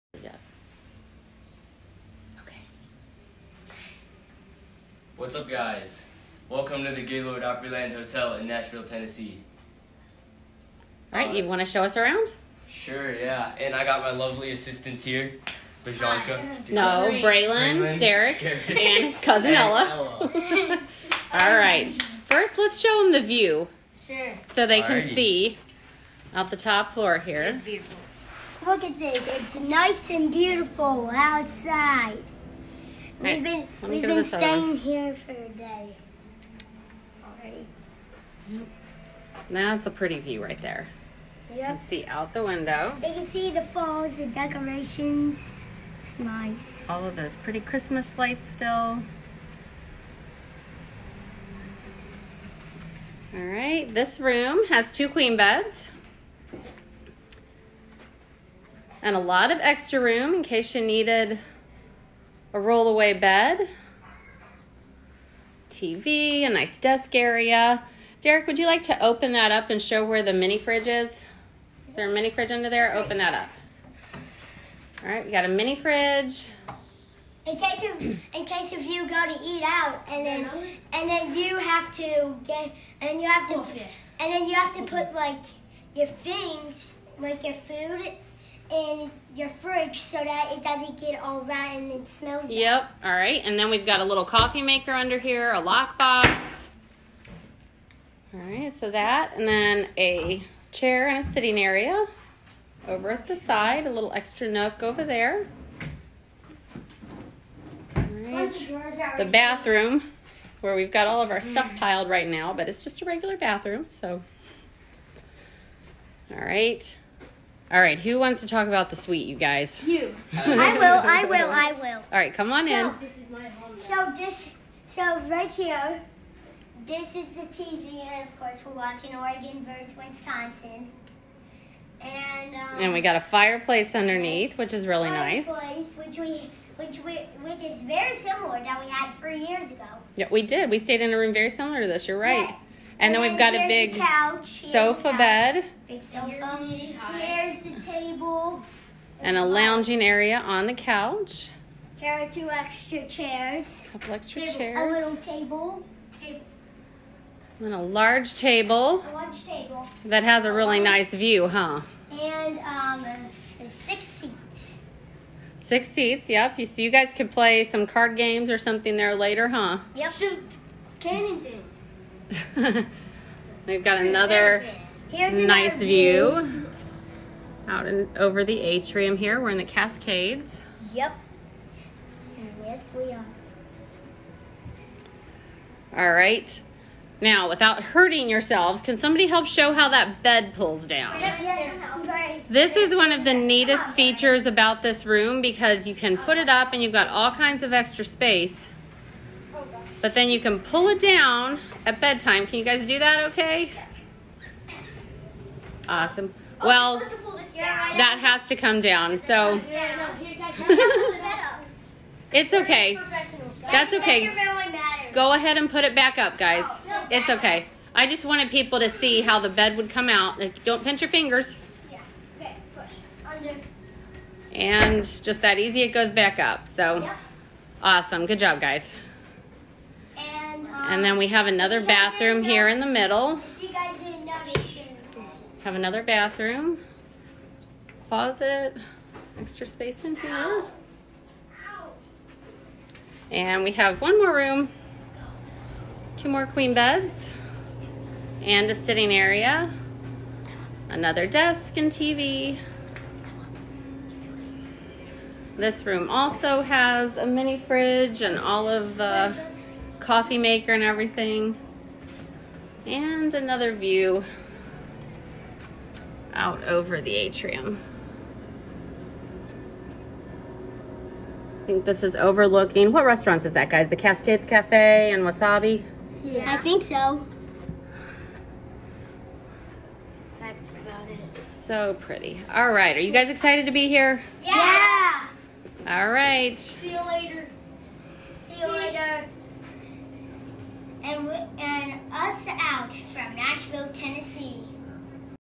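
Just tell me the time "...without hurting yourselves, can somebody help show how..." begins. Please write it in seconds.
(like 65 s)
187 s.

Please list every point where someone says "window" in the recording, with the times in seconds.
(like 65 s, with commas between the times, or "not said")
42 s.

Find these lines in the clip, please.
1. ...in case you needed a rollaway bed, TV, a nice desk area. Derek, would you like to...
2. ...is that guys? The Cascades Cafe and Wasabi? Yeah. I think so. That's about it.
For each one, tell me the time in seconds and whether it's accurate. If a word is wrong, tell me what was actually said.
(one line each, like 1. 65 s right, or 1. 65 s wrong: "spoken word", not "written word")
1. 60 s right
2. 273 s right.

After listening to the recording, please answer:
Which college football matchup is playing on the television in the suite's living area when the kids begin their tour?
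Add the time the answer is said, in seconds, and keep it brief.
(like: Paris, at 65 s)
Oregon versus Wisconsin, at 129 s.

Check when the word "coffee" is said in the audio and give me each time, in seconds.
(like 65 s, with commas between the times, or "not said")
94 s, 260 s.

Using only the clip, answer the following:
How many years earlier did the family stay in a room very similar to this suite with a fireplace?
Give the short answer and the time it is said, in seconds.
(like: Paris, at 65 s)
3, at 139 s.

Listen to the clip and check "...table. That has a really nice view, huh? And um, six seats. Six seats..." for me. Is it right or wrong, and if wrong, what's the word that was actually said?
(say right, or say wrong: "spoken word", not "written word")
right.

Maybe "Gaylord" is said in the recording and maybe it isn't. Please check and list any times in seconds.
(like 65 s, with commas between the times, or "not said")
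7 s.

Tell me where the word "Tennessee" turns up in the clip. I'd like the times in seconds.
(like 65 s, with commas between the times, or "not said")
8 s, 293 s.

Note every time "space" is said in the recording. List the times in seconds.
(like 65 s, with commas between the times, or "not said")
198 s, 239 s.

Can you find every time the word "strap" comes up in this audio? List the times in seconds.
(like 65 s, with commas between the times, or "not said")
not said.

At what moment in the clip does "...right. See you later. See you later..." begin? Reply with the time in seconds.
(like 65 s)
286 s.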